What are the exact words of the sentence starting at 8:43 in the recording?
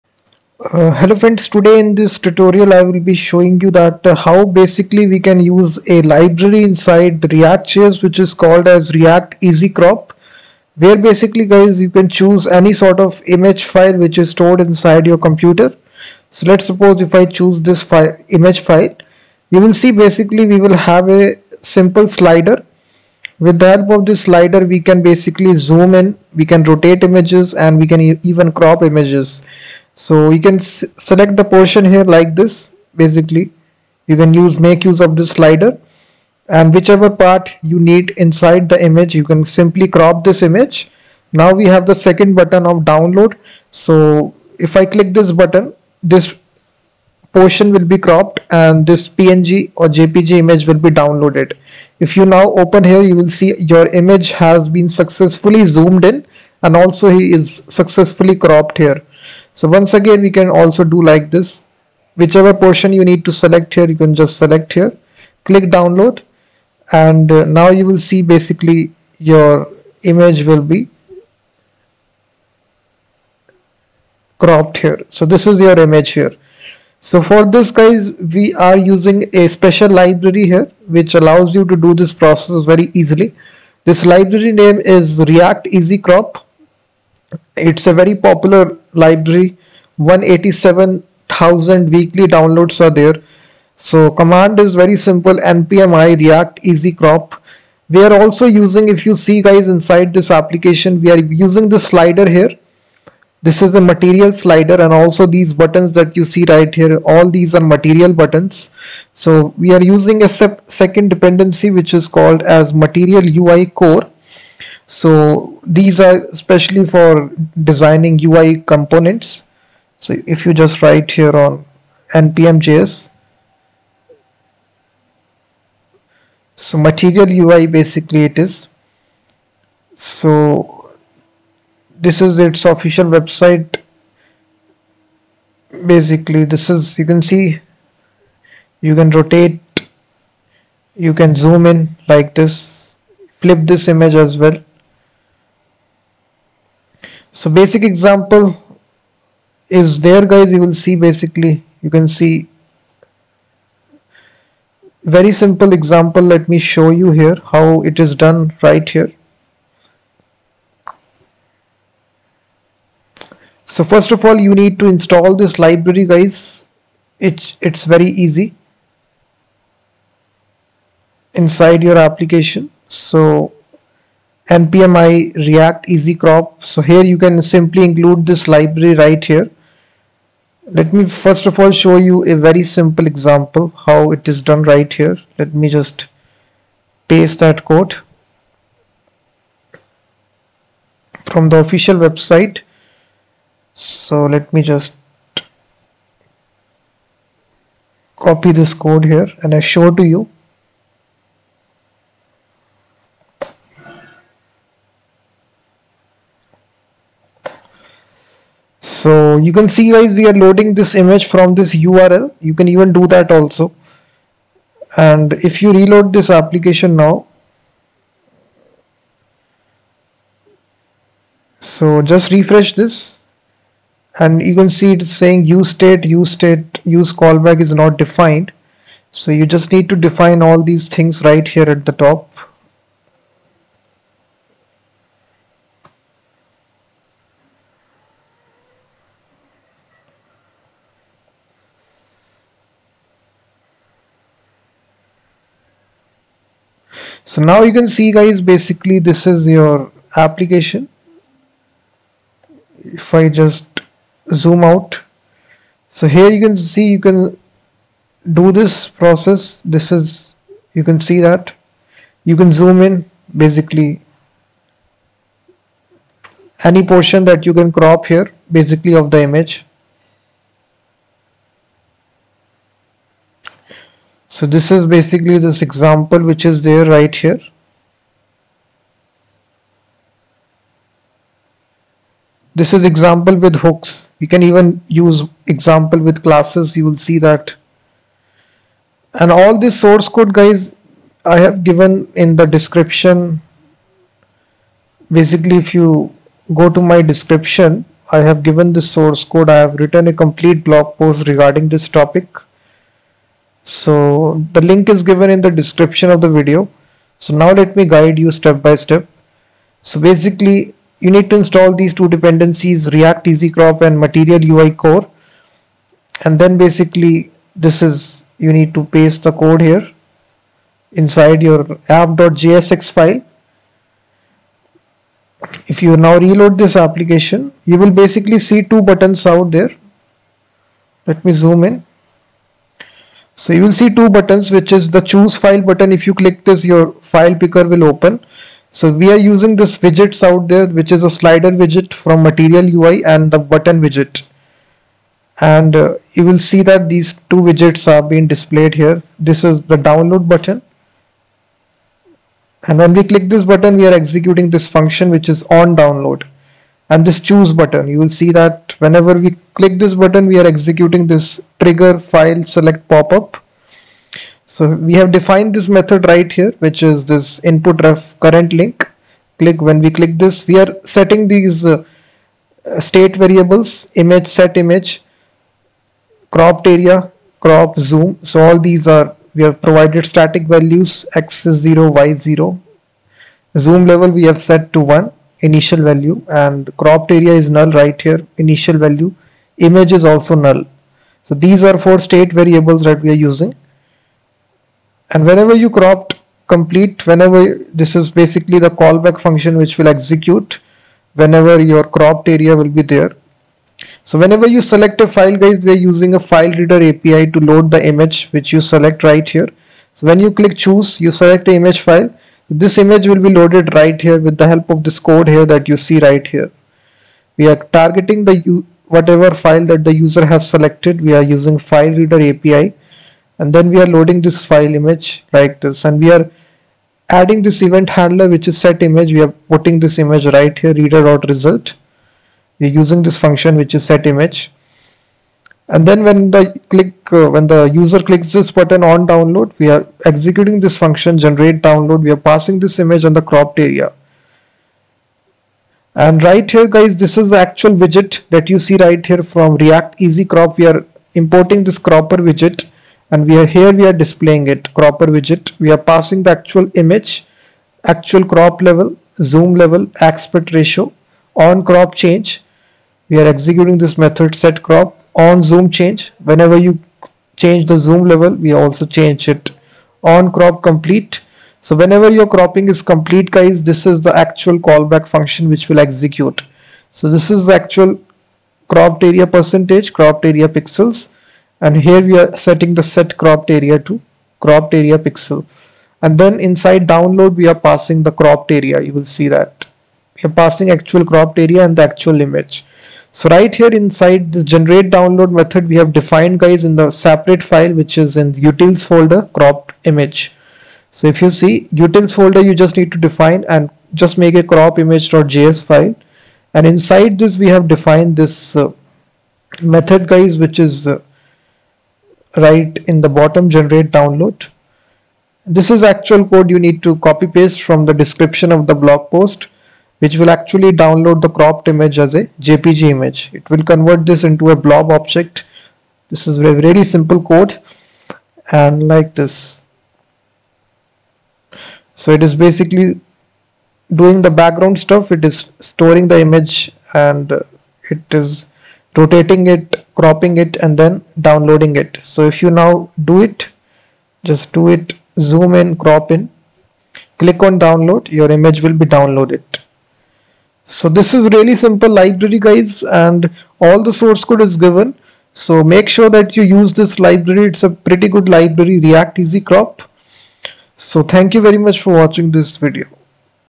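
It will convert this into a blob object.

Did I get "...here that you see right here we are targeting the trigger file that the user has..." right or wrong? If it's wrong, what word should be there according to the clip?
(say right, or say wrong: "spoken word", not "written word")
wrong: "whatever", not "trigger".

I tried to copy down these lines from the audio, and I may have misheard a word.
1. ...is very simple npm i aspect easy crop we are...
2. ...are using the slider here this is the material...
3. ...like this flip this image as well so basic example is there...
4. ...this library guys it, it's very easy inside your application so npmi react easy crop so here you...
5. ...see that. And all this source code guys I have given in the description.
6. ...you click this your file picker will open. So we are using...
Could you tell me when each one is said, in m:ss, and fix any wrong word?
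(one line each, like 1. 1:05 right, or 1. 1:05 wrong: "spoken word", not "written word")
1. 1:34 wrong: "react", not "aspect"
2. 1:41 right
3. 2:22 right
4. 2:45 right
5. 4:46 right
6. 5:36 right.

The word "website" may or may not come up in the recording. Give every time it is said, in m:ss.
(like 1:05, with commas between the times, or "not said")
2:13, 3:11.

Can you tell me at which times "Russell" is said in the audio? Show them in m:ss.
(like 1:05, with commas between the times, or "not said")
not said.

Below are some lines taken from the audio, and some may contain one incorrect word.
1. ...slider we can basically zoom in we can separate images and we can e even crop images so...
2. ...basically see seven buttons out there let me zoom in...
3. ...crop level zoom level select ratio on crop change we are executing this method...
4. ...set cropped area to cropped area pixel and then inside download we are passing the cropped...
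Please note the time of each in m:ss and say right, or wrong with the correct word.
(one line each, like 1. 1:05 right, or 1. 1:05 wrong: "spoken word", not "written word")
1. 0:24 wrong: "rotate", not "separate"
2. 5:27 wrong: "two", not "seven"
3. 7:38 wrong: "aspect", not "select"
4. 8:02 right.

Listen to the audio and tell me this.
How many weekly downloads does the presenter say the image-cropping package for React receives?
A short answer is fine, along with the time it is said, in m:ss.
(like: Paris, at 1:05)
187,000, at 1:29.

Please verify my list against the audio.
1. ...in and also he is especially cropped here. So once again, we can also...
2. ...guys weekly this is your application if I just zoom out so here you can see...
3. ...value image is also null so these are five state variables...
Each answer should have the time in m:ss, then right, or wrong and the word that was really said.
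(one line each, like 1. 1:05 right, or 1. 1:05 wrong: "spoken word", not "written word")
1. 0:56 wrong: "successfully", not "especially"
2. 4:08 wrong: "basically", not "weekly"
3. 6:28 wrong: "four", not "five".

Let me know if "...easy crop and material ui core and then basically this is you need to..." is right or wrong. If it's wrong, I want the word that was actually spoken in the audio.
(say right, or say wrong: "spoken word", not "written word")
right.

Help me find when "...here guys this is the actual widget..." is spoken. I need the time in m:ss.
7:26.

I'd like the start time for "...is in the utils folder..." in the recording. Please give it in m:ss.
8:17.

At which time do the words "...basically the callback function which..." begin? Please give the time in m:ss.
6:38.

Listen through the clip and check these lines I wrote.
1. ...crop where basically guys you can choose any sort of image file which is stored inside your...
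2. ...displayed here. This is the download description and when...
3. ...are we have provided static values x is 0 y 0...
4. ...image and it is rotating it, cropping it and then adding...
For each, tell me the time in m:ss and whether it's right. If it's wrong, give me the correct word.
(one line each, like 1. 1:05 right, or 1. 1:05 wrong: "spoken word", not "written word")
1. 0:09 right
2. 5:48 wrong: "button", not "description"
3. 6:18 right
4. 8:56 wrong: "downloading", not "adding".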